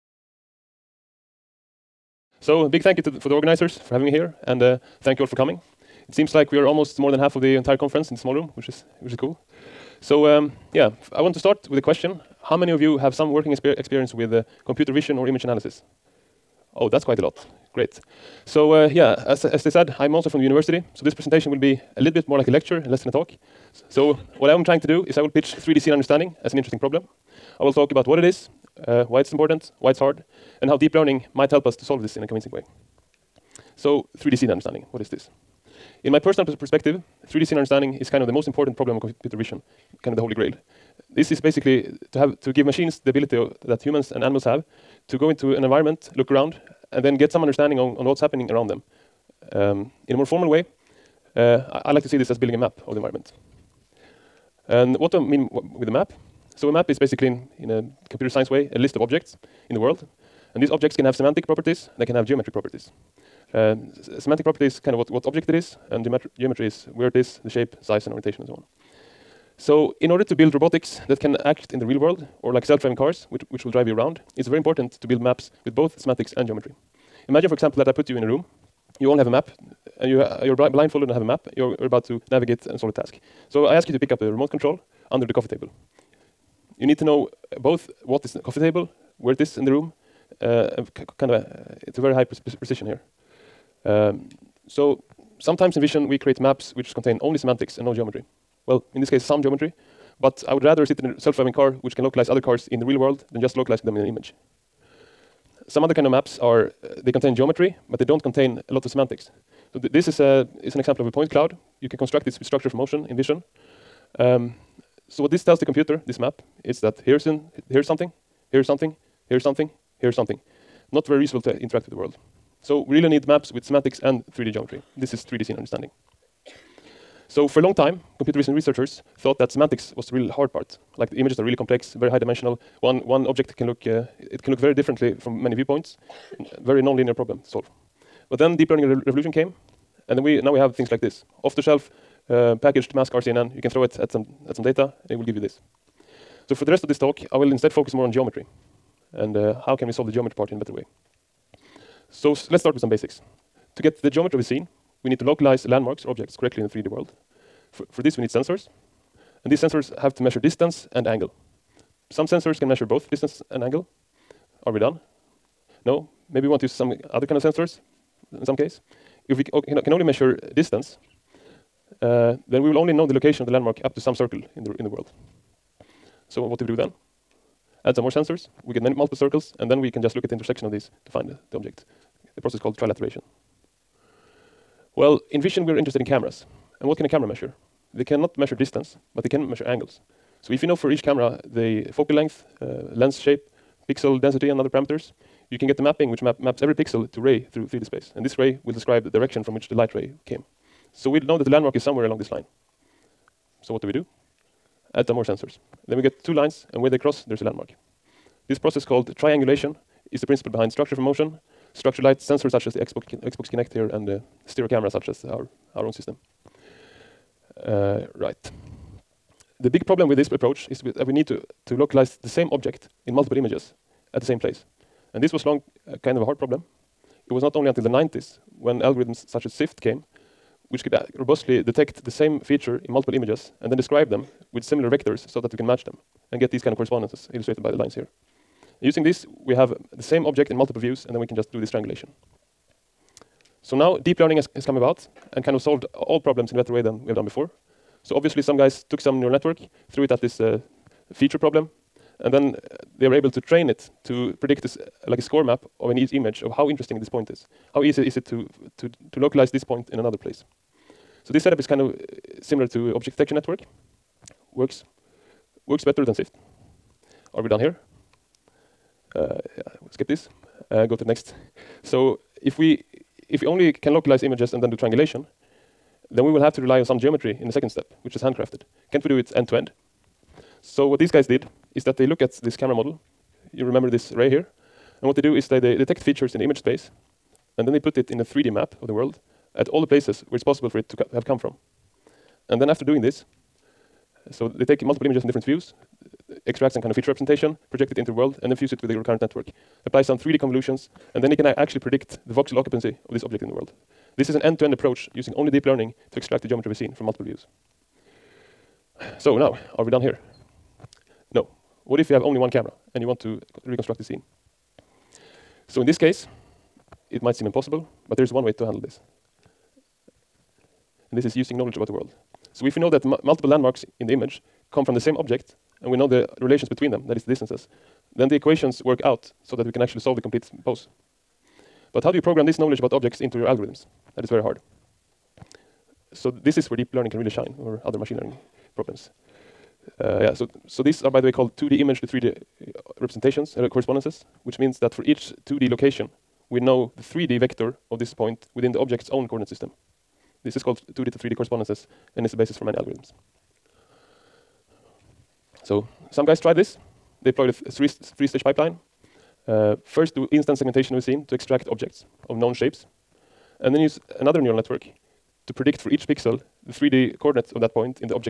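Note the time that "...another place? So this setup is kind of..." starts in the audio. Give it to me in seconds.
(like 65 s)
259 s.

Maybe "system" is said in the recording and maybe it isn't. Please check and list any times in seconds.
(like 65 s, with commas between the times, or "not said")
215 s, 349 s.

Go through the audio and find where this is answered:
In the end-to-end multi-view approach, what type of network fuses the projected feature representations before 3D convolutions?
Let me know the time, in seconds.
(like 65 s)
298 s.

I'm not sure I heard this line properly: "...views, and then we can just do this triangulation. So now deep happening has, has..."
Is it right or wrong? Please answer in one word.
wrong.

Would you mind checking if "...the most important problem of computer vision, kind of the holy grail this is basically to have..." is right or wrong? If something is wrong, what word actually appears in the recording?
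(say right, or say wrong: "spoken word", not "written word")
right.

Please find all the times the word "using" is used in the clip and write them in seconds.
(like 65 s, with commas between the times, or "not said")
238 s, 305 s, 321 s.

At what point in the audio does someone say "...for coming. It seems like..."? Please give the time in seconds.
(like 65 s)
5 s.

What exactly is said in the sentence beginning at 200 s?
So we know that the landmark is somewhere along this line.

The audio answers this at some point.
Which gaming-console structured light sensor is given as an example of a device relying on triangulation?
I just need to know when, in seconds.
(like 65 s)
213 s.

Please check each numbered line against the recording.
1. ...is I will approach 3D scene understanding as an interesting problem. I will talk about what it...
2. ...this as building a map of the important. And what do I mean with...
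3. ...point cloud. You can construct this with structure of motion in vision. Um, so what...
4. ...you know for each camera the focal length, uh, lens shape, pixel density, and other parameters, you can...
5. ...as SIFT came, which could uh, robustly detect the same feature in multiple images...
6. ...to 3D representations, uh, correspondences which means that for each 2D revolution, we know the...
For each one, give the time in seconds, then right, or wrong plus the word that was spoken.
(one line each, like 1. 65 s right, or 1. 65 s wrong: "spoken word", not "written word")
1. 25 s wrong: "pitch", not "approach"
2. 52 s wrong: "environment", not "important"
3. 111 s right
4. 190 s right
5. 229 s right
6. 342 s wrong: "location", not "revolution".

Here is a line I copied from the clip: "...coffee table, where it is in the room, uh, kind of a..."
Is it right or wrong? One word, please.
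right.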